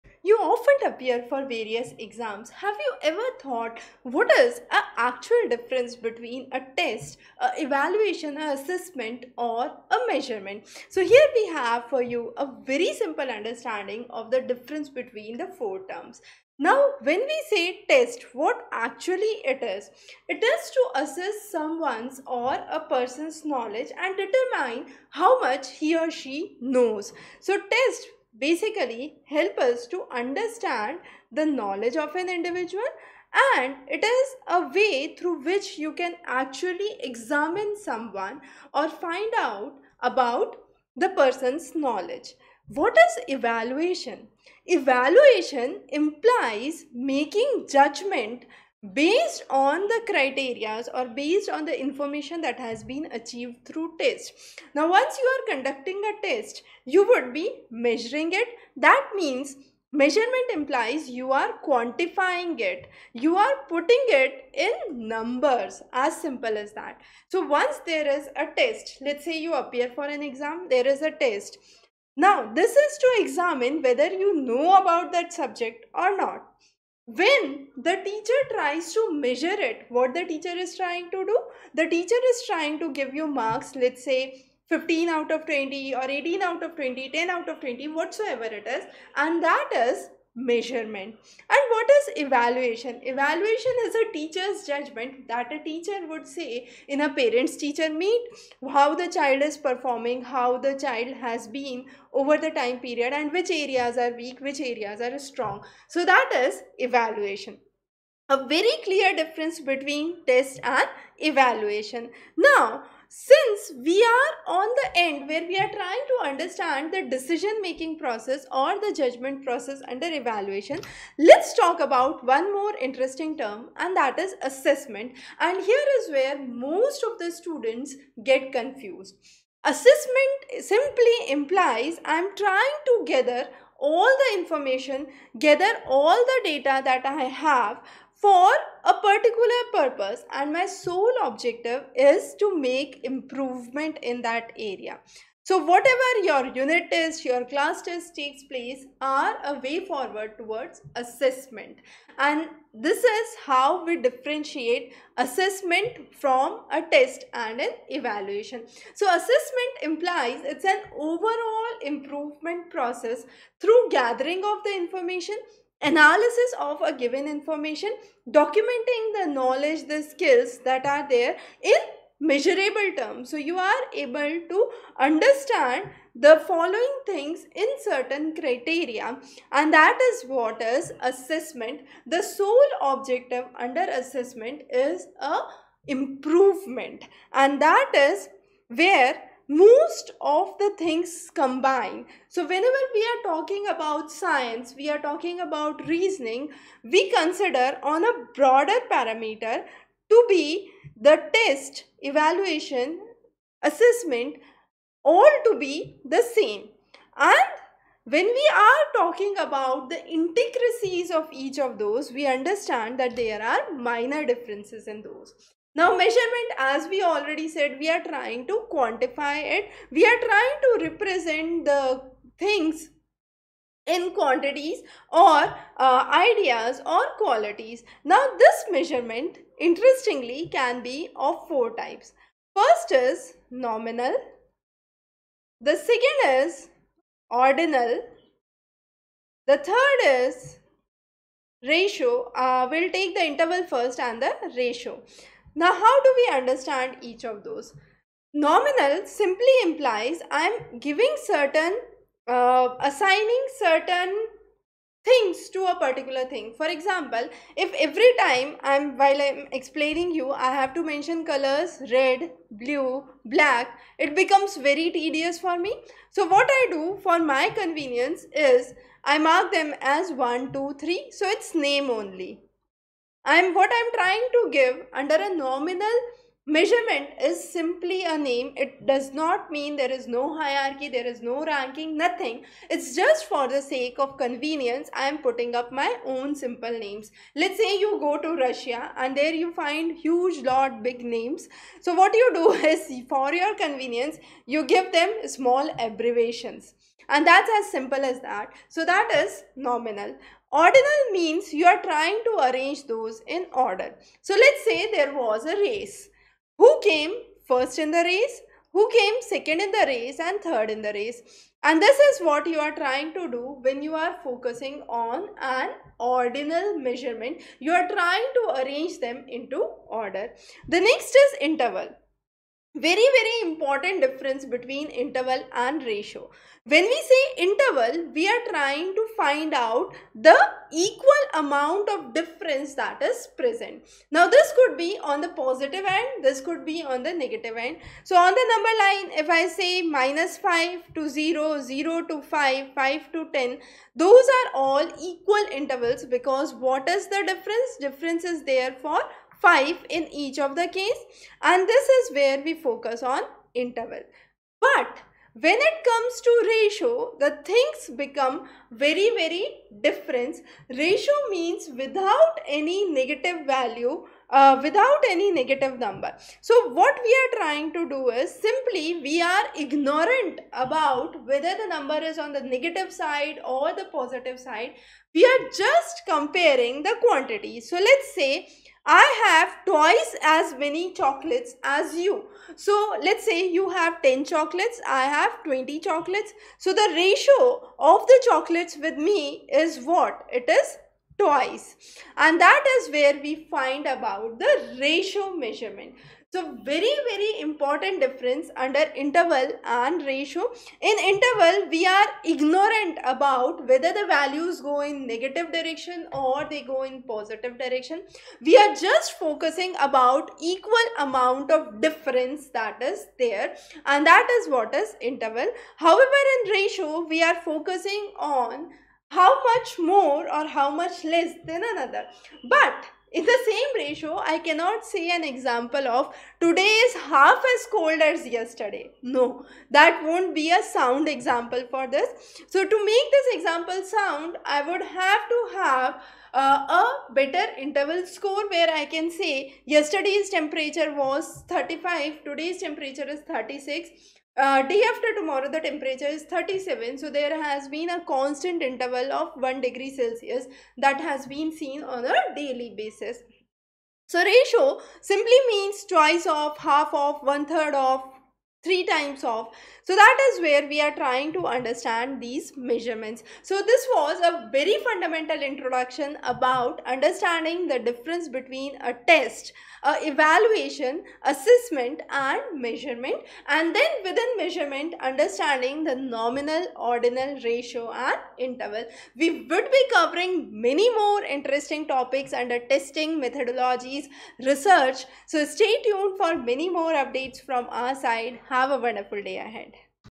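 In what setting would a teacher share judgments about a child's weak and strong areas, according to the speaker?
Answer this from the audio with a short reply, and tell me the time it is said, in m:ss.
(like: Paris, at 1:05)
parents teacher meet, at 1:37.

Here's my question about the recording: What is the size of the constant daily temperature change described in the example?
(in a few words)
1 degree Celsius.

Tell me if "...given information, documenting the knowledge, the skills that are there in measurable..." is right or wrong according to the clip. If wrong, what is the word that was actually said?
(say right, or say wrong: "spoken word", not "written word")
right.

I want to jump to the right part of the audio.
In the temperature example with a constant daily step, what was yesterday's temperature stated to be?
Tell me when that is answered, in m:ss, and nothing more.
7:21.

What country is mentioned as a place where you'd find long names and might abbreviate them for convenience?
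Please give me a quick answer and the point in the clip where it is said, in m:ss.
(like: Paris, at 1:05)
Russia, at 4:48.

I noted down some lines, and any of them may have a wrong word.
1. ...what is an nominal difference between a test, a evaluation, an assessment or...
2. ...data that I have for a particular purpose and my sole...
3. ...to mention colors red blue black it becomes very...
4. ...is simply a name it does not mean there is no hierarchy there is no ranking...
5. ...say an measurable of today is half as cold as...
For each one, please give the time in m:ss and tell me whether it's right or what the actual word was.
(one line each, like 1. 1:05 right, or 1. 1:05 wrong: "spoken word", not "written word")
1. 0:04 wrong: "actual", not "nominal"
2. 2:16 right
3. 4:20 right
4. 4:37 right
5. 7:04 wrong: "example", not "measurable".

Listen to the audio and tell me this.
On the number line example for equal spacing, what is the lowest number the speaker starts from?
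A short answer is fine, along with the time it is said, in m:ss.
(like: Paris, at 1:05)
-5, at 5:39.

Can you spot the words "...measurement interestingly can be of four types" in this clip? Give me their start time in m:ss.
3:48.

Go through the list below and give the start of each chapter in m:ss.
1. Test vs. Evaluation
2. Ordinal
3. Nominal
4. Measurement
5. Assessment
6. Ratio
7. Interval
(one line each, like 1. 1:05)
1. 0:12
2. 5:01
3. 4:13
4. 3:35
5. 2:03
6. 5:57
7. 5:22.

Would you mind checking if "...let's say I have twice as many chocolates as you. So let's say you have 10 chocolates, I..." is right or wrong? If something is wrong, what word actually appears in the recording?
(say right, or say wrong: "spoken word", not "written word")
right.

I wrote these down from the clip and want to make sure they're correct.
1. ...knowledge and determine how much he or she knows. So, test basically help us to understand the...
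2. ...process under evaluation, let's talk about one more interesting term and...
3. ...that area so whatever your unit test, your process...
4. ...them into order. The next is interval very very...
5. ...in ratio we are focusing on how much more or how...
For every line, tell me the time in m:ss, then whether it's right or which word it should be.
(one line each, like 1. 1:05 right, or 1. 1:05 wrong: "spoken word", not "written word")
1. 0:23 right
2. 1:59 right
3. 2:24 wrong: "class", not "process"
4. 5:18 right
5. 6:56 right.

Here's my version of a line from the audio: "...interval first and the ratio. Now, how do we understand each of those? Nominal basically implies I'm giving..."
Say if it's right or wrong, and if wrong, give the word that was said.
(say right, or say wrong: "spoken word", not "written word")
wrong: "simply", not "basically".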